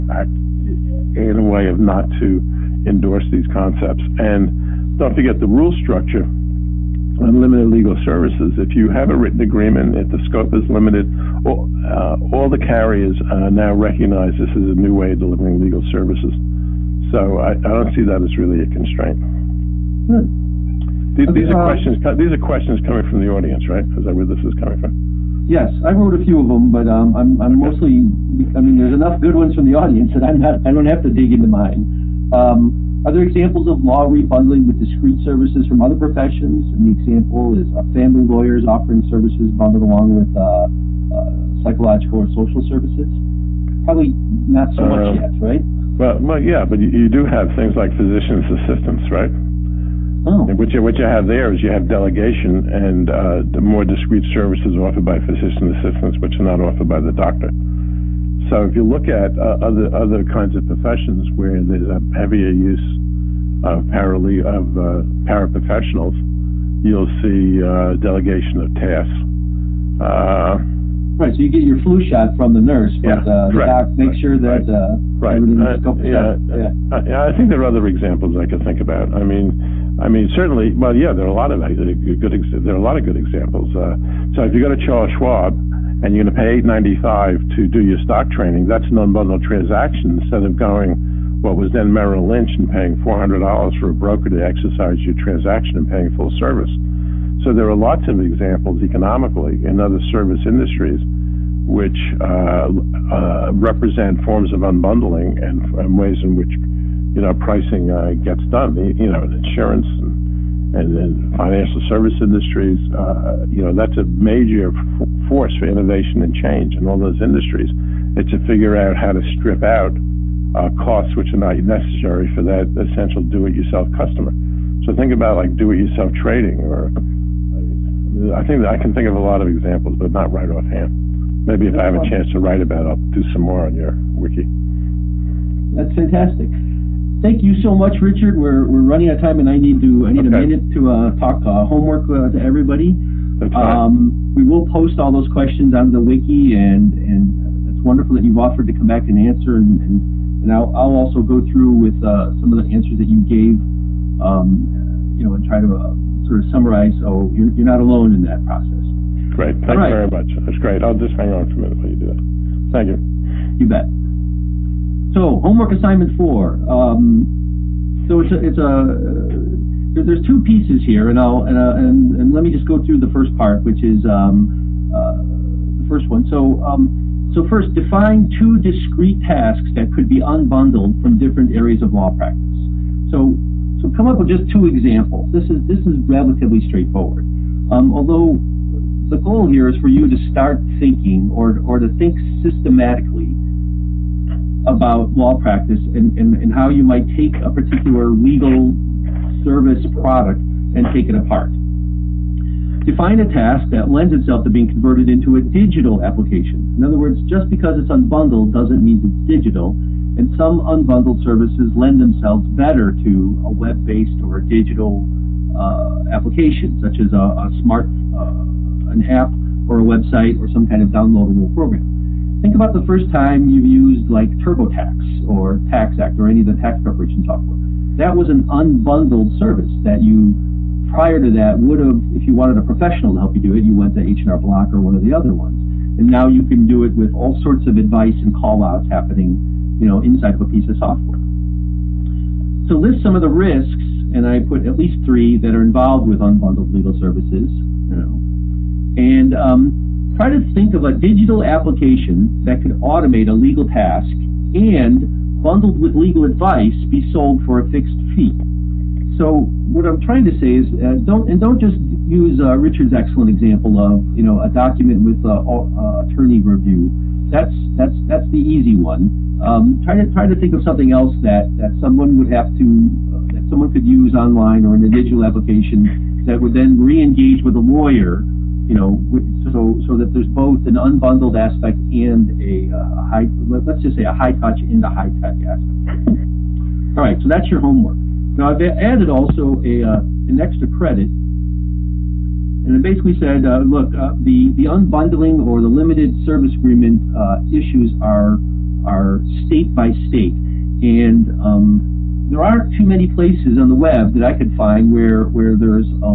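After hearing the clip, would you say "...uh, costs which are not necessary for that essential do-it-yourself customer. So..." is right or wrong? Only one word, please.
right.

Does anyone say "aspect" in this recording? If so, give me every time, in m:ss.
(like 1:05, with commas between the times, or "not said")
4:41, 4:45.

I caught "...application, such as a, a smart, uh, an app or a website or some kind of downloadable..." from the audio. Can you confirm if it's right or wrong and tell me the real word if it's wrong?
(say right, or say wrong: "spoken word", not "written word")
right.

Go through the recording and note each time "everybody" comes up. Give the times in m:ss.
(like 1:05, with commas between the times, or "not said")
2:22.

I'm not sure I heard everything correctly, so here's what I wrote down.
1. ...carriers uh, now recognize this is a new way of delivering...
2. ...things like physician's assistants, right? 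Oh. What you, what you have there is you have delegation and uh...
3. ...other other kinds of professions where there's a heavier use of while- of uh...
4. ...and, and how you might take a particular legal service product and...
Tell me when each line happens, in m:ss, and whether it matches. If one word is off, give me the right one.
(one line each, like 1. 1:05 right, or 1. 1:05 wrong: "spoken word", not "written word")
1. 0:12 right
2. 0:47 right
3. 0:59 wrong: "parale", not "while"
4. 3:16 right.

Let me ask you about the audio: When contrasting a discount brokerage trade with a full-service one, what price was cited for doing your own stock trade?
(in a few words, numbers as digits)
$8.95.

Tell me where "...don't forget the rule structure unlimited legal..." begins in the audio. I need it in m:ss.
0:04.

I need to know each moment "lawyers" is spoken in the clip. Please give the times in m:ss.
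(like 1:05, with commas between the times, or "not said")
0:38, 4:37.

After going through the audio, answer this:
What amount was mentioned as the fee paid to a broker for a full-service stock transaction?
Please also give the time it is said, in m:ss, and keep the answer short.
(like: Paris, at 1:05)
$400, at 1:33.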